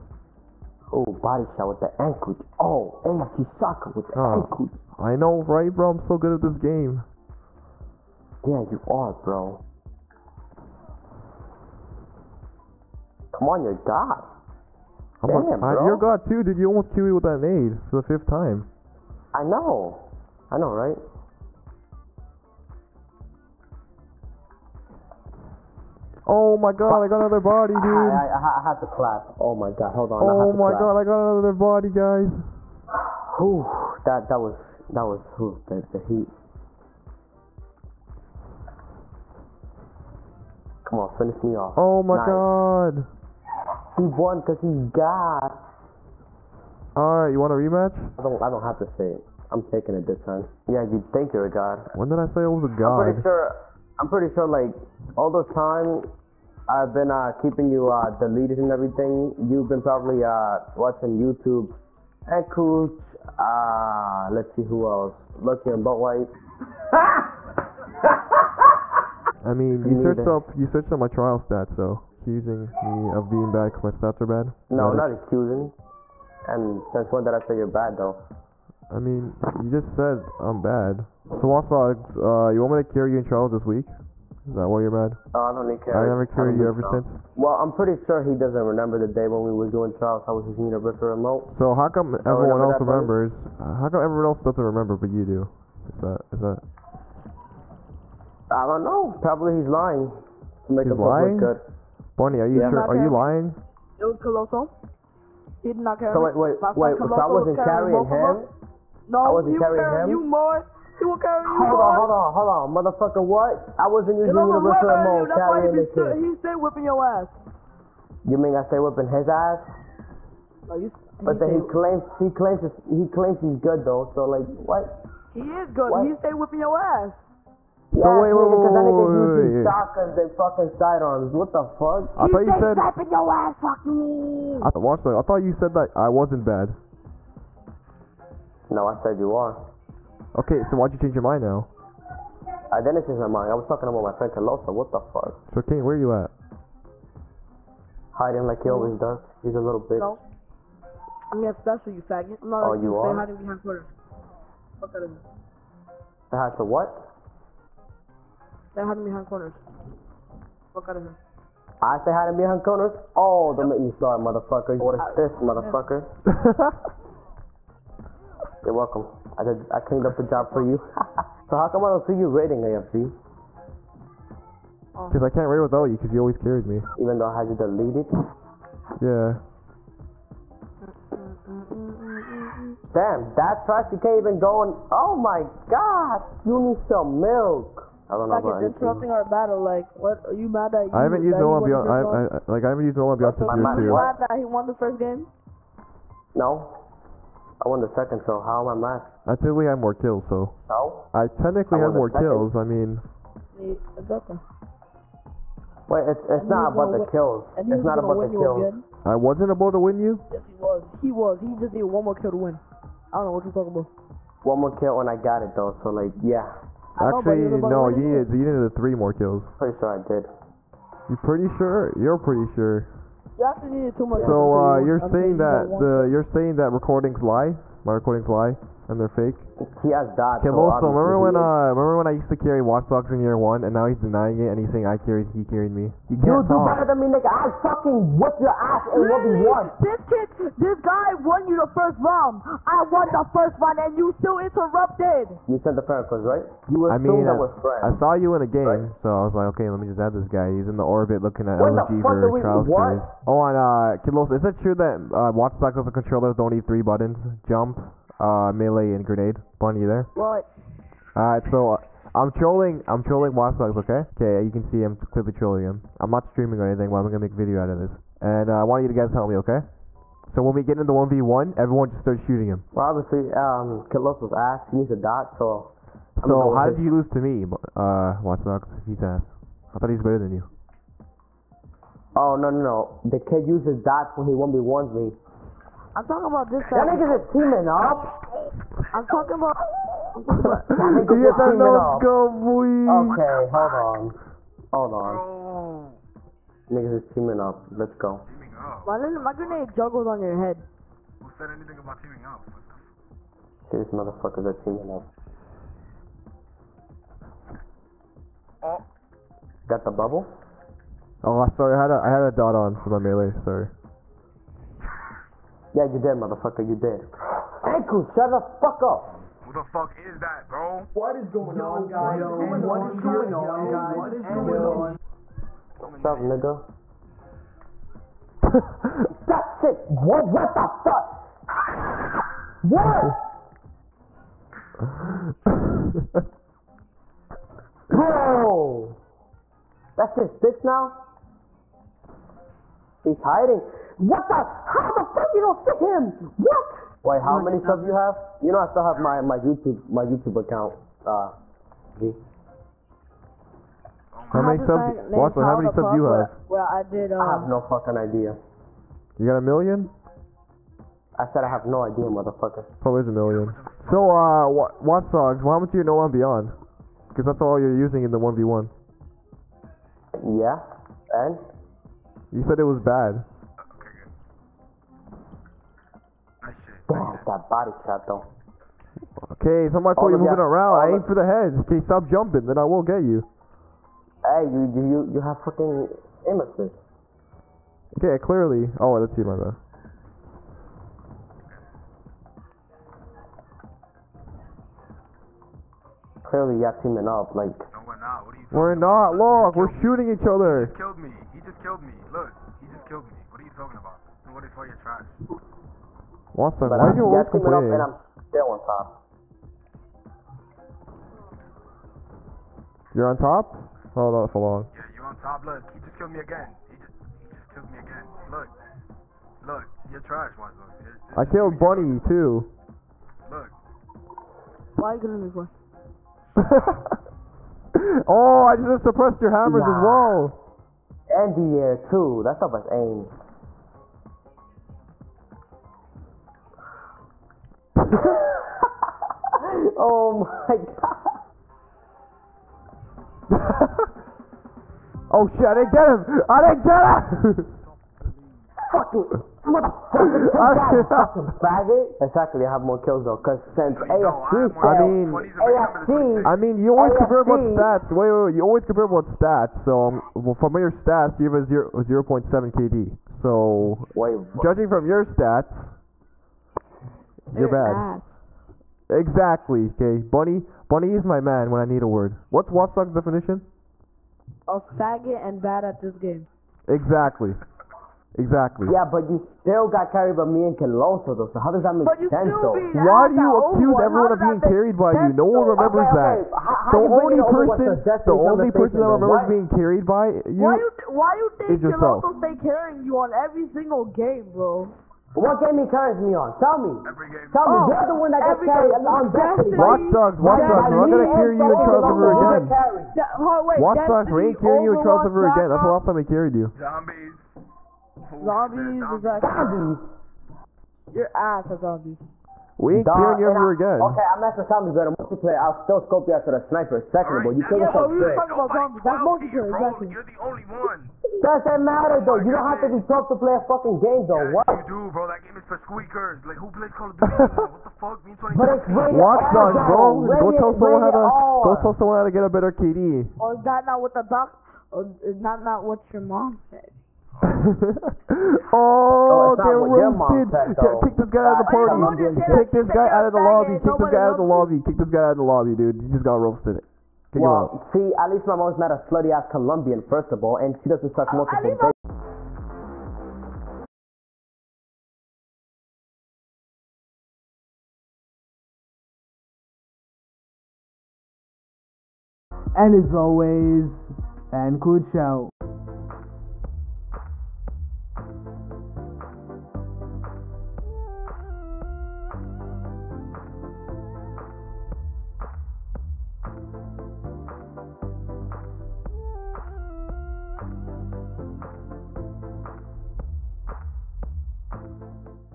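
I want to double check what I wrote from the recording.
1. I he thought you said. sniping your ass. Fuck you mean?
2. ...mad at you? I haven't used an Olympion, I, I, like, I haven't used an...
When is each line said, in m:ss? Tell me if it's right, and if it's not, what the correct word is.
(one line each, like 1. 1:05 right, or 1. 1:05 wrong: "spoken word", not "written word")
1. 2:12 right
2. 3:10 right.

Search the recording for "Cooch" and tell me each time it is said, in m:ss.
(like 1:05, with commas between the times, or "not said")
1:02.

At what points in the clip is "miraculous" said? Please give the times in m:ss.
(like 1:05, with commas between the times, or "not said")
not said.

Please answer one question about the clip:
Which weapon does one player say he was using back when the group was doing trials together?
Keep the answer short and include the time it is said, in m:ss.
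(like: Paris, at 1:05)
Universal Remote, at 1:30.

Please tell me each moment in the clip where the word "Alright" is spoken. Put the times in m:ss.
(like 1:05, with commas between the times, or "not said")
0:46, 4:21.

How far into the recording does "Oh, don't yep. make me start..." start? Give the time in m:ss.
2:43.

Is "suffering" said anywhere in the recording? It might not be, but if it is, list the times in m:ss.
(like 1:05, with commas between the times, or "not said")
not said.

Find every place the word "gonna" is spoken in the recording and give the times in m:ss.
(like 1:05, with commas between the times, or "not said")
2:31, 4:27, 8:20.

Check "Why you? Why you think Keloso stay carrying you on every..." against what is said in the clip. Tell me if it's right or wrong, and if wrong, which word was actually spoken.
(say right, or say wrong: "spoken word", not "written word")
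right.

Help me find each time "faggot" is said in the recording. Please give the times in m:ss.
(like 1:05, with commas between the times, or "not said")
2:32, 7:31, 7:54.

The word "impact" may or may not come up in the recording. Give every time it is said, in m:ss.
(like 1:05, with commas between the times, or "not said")
not said.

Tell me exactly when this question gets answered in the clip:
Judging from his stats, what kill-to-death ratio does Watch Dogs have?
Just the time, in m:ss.
7:42.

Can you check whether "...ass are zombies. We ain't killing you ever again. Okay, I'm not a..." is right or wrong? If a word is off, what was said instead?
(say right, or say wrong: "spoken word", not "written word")
right.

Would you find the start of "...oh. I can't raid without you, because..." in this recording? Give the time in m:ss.
2:55.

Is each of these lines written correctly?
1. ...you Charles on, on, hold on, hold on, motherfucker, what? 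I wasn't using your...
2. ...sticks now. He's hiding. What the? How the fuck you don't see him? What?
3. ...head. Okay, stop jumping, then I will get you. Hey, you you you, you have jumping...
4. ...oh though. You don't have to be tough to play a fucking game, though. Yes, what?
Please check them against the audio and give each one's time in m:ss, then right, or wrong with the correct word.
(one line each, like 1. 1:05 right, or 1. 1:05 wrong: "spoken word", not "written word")
1. 1:51 wrong: "Hold", not "Charles"
2. 5:40 right
3. 6:21 wrong: "fucking", not "jumping"
4. 8:42 right.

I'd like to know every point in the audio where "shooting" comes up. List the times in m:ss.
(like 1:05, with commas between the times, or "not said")
4:32, 6:39.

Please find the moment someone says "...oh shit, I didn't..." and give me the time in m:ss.
7:25.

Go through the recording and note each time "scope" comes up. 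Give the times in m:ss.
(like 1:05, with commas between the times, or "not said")
4:51, 8:35.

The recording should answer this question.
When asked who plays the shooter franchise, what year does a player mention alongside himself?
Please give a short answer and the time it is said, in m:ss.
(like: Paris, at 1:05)
2017, at 8:48.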